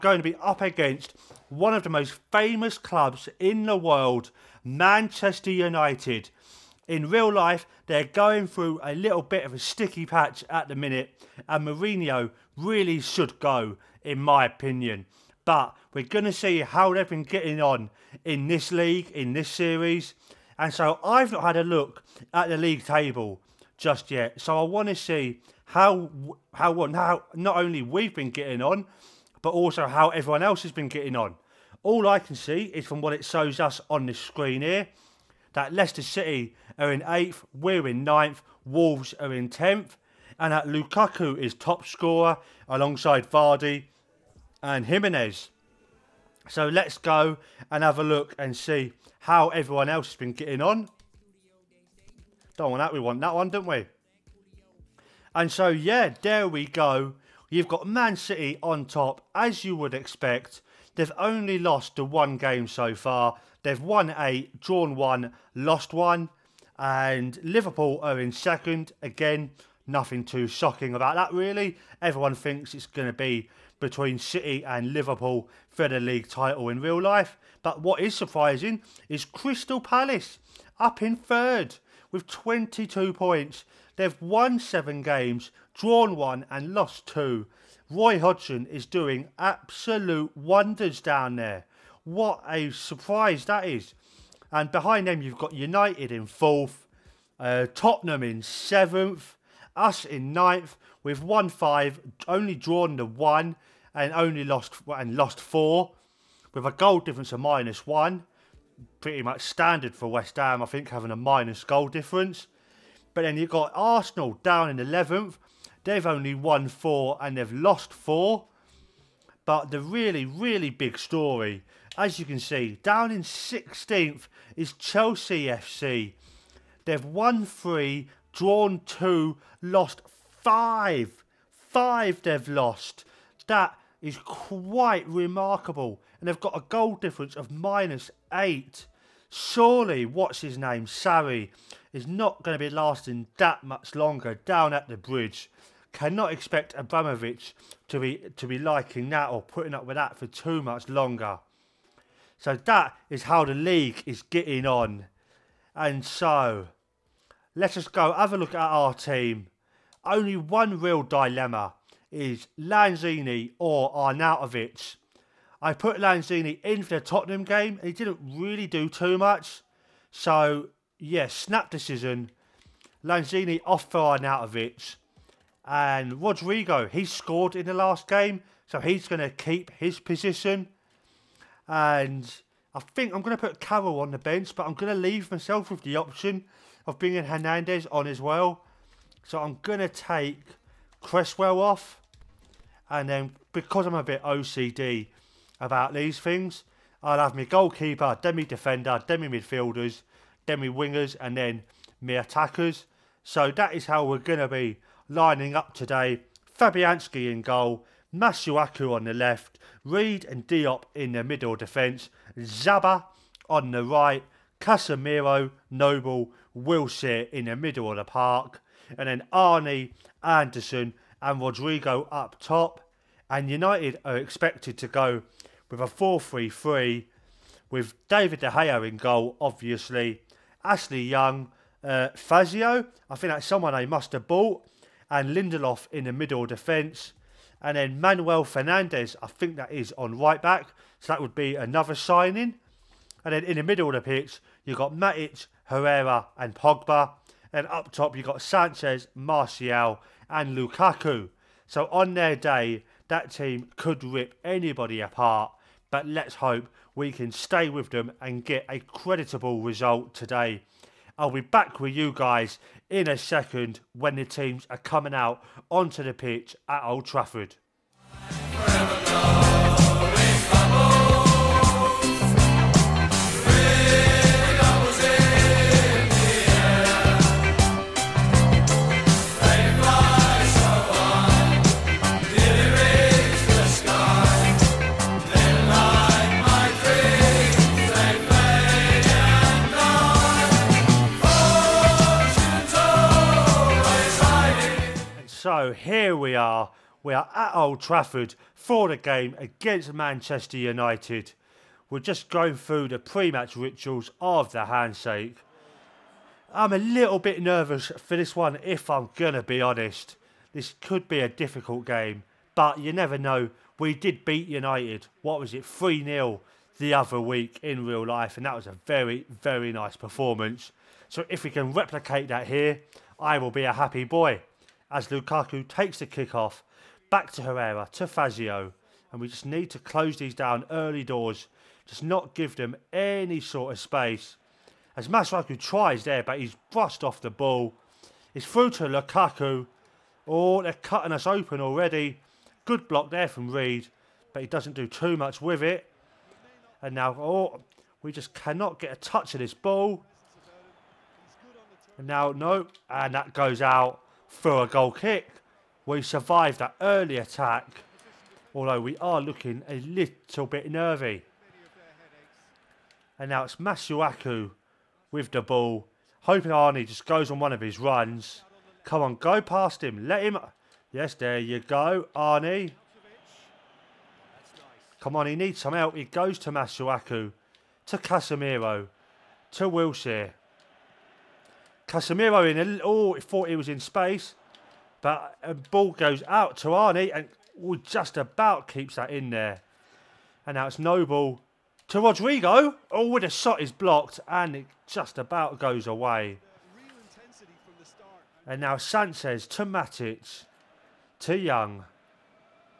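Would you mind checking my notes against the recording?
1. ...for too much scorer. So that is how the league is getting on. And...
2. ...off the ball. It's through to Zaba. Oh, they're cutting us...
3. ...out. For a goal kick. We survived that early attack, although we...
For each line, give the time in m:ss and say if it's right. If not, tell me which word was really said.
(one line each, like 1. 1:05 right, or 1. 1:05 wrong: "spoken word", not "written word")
1. 2:30 wrong: "longer", not "scorer"
2. 5:37 wrong: "Lukaku", not "Zaba"
3. 5:53 right.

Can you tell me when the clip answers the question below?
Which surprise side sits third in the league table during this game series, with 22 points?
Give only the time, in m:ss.
1:19.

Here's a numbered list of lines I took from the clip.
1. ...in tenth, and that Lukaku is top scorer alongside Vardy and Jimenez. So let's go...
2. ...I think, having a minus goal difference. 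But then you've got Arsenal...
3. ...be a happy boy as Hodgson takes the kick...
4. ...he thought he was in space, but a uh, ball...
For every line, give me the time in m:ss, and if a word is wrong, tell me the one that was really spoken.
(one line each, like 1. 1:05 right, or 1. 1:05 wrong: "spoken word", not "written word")
1. 0:39 right
2. 1:50 right
3. 5:23 wrong: "Lukaku", not "Hodgson"
4. 6:23 right.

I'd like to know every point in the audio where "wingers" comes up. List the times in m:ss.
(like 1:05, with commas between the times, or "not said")
3:20.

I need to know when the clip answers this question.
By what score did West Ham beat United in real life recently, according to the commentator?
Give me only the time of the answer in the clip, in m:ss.
5:15.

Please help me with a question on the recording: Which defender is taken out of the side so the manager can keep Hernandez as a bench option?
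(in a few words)
Cresswell.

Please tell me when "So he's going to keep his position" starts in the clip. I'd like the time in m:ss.
2:58.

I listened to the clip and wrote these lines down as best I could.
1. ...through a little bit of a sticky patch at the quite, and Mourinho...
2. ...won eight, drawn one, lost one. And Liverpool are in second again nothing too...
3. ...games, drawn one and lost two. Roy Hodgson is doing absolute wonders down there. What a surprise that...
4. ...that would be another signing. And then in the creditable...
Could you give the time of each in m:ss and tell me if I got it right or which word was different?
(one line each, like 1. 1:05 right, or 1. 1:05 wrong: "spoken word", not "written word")
1. 0:08 wrong: "minute", not "quite"
2. 1:03 right
3. 1:25 right
4. 4:01 wrong: "middle", not "creditable".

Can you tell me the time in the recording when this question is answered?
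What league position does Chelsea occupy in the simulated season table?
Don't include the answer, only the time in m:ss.
2:03.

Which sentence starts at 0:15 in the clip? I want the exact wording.
But we're going to see how they've been getting on in this league, in this series.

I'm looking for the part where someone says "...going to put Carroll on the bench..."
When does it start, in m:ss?
3:03.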